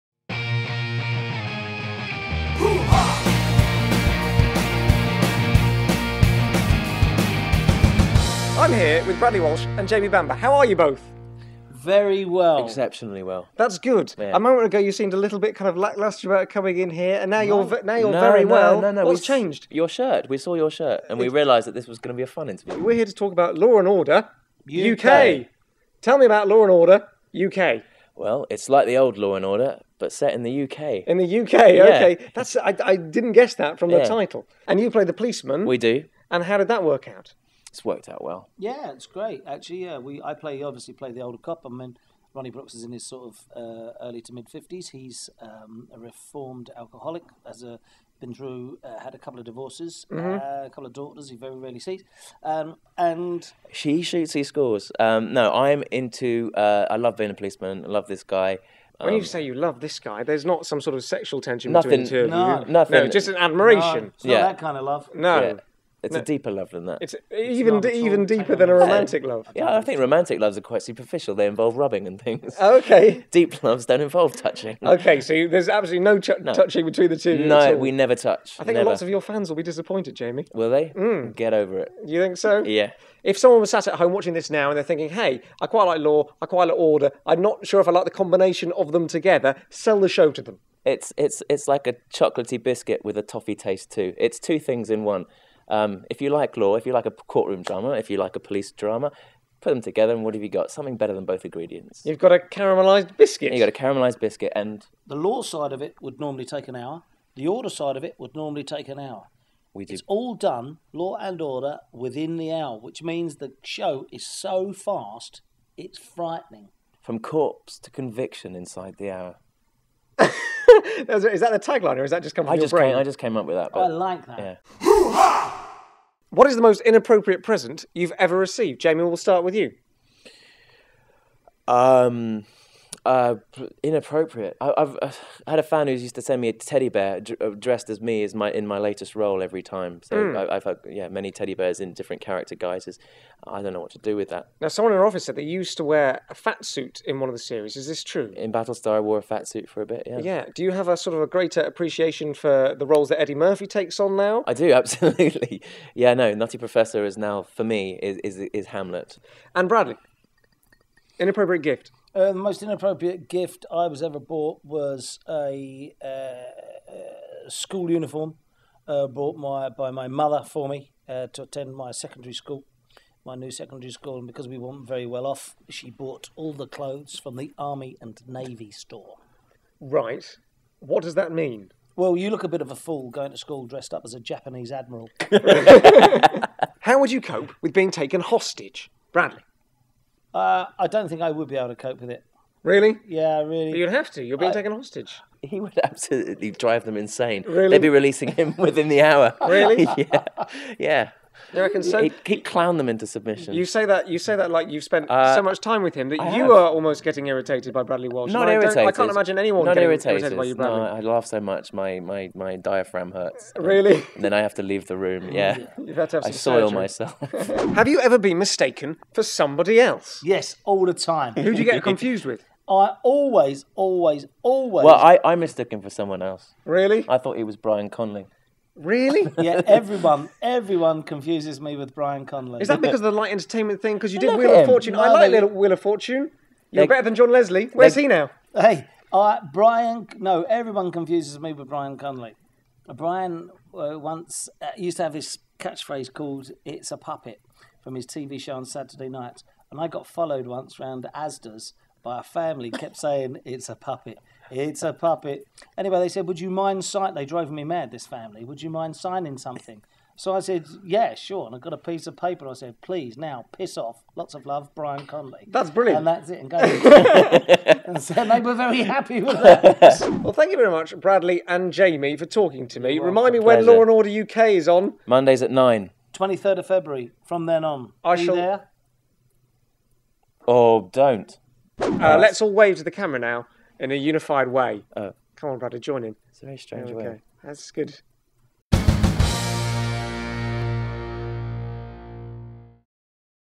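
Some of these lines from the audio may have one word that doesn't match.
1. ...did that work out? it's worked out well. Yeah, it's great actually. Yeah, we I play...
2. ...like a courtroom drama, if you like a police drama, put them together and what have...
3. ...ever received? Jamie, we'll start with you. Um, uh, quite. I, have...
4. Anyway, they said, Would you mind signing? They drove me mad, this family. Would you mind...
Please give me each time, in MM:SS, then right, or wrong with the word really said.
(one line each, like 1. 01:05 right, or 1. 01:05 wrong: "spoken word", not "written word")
1. 00:36 right
2. 01:36 right
3. 02:08 wrong: "inappropriate", not "quite"
4. 04:15 right.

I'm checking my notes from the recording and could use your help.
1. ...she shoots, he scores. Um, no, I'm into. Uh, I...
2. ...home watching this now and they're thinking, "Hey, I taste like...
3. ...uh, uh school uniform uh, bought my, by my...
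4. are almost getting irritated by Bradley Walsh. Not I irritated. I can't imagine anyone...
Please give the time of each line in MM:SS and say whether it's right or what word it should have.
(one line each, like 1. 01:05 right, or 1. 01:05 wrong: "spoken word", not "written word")
1. 00:53 right
2. 01:23 wrong: "quite", not "taste"
3. 02:46 right
4. 03:26 right.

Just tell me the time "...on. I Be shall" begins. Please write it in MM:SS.
04:37.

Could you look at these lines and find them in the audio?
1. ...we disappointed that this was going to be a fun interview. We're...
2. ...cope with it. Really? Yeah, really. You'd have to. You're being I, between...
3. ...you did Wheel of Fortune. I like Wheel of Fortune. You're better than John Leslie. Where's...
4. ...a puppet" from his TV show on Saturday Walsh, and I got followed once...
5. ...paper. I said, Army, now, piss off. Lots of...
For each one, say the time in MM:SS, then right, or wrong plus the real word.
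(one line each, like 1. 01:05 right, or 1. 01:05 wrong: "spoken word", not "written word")
1. 00:21 wrong: "realised", not "disappointed"
2. 03:11 wrong: "taken", not "between"
3. 03:54 right
4. 04:06 wrong: "Night", not "Walsh"
5. 04:22 wrong: "Please", not "Army".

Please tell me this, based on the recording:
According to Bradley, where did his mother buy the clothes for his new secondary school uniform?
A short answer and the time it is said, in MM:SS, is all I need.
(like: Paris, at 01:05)
Army and Navy store, at 02:57.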